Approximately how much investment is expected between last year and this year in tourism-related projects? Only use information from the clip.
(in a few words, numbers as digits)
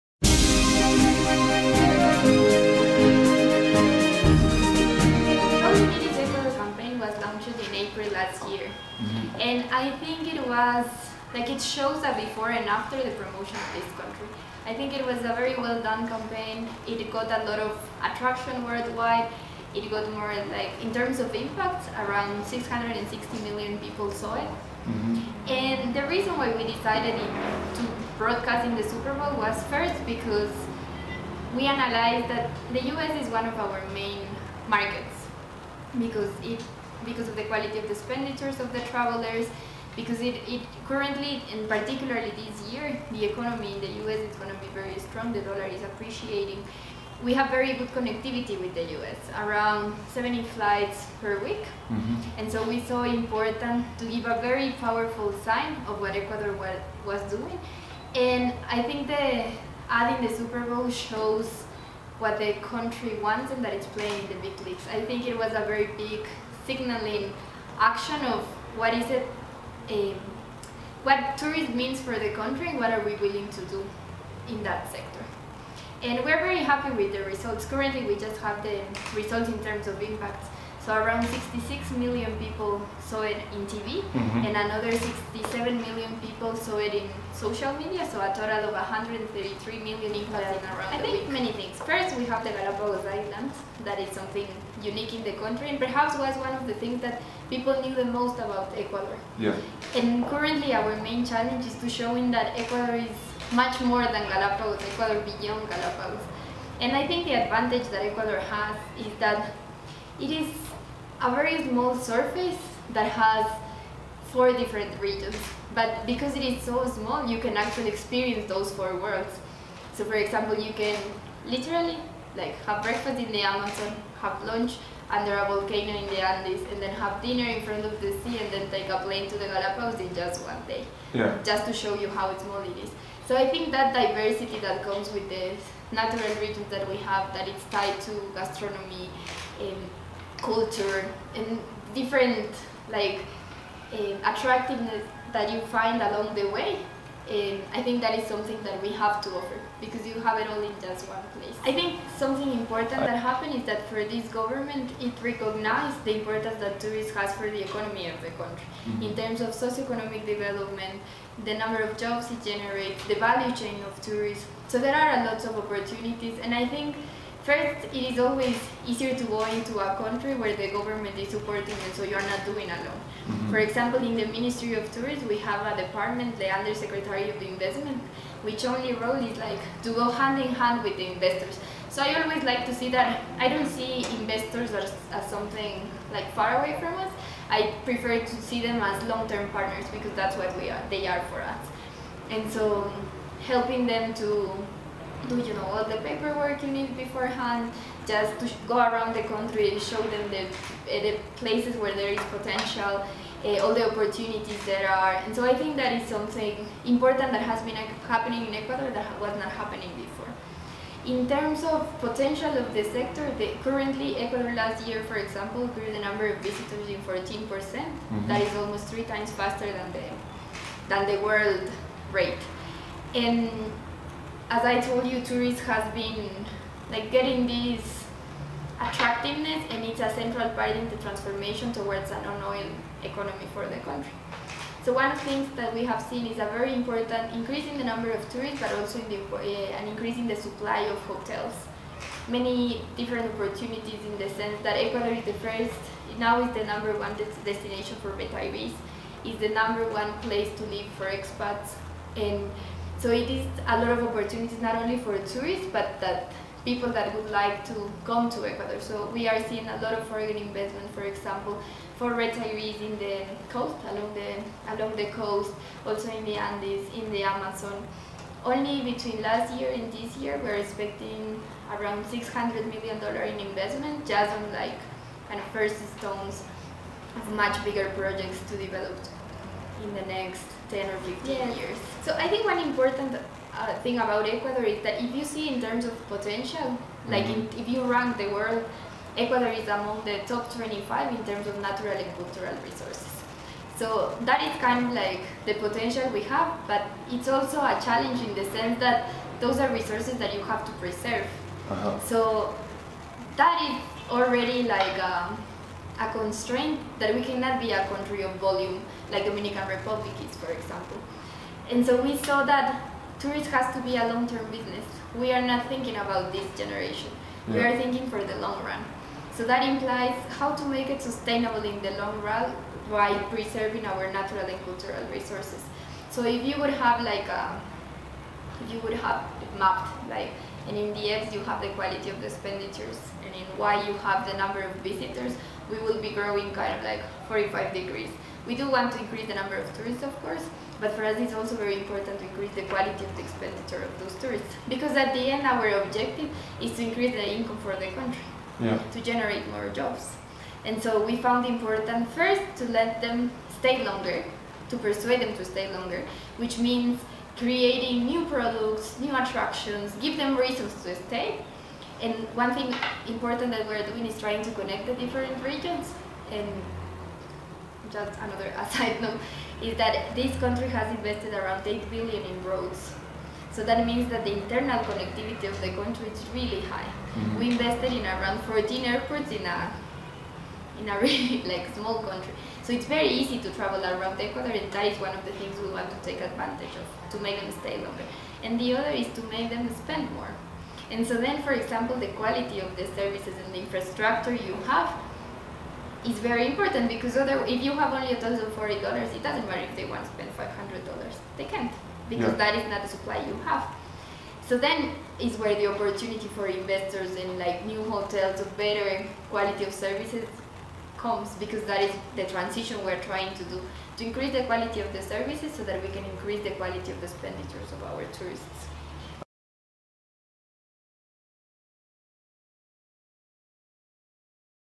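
$600 million.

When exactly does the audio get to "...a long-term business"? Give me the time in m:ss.
5:13.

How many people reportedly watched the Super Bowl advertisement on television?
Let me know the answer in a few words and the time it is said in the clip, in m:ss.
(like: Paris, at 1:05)
66 million, at 1:21.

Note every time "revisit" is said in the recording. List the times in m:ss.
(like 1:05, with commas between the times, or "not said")
not said.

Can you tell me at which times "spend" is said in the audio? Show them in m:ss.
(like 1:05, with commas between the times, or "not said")
6:29, 6:40.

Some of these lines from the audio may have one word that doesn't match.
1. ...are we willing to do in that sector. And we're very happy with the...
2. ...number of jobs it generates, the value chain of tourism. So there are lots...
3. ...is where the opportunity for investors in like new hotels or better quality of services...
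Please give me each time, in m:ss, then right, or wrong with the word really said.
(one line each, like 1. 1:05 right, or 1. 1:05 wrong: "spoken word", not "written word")
1. 1:12 right
2. 2:41 right
3. 6:45 right.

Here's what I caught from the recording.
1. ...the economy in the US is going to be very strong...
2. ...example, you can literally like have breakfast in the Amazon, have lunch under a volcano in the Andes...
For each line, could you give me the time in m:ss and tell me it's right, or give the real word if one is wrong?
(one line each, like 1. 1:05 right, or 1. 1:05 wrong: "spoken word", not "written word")
1. 0:43 right
2. 2:00 right.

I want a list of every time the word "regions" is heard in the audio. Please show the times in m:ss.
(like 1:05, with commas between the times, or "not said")
1:54, 2:16, 6:05.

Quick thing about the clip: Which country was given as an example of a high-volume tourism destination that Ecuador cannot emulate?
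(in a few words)
Dominican Republic.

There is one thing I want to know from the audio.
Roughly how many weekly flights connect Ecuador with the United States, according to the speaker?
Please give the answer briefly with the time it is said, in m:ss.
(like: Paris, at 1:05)
70, at 0:49.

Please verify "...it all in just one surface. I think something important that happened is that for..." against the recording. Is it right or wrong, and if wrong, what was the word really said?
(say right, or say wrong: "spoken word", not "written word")
wrong: "place", not "surface".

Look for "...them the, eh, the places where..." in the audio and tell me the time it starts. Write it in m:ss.
3:20.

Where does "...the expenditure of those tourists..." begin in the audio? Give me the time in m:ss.
5:43.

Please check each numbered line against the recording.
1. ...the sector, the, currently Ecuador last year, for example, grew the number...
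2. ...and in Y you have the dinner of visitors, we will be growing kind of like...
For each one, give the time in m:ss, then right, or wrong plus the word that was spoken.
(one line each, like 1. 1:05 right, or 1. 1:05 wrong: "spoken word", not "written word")
1. 3:32 right
2. 5:33 wrong: "number", not "dinner".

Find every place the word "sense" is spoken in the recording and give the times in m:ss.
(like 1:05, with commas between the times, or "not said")
4:04, 4:58.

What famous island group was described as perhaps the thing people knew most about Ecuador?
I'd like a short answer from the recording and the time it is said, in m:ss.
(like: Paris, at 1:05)
Galapagos Islands, at 1:32.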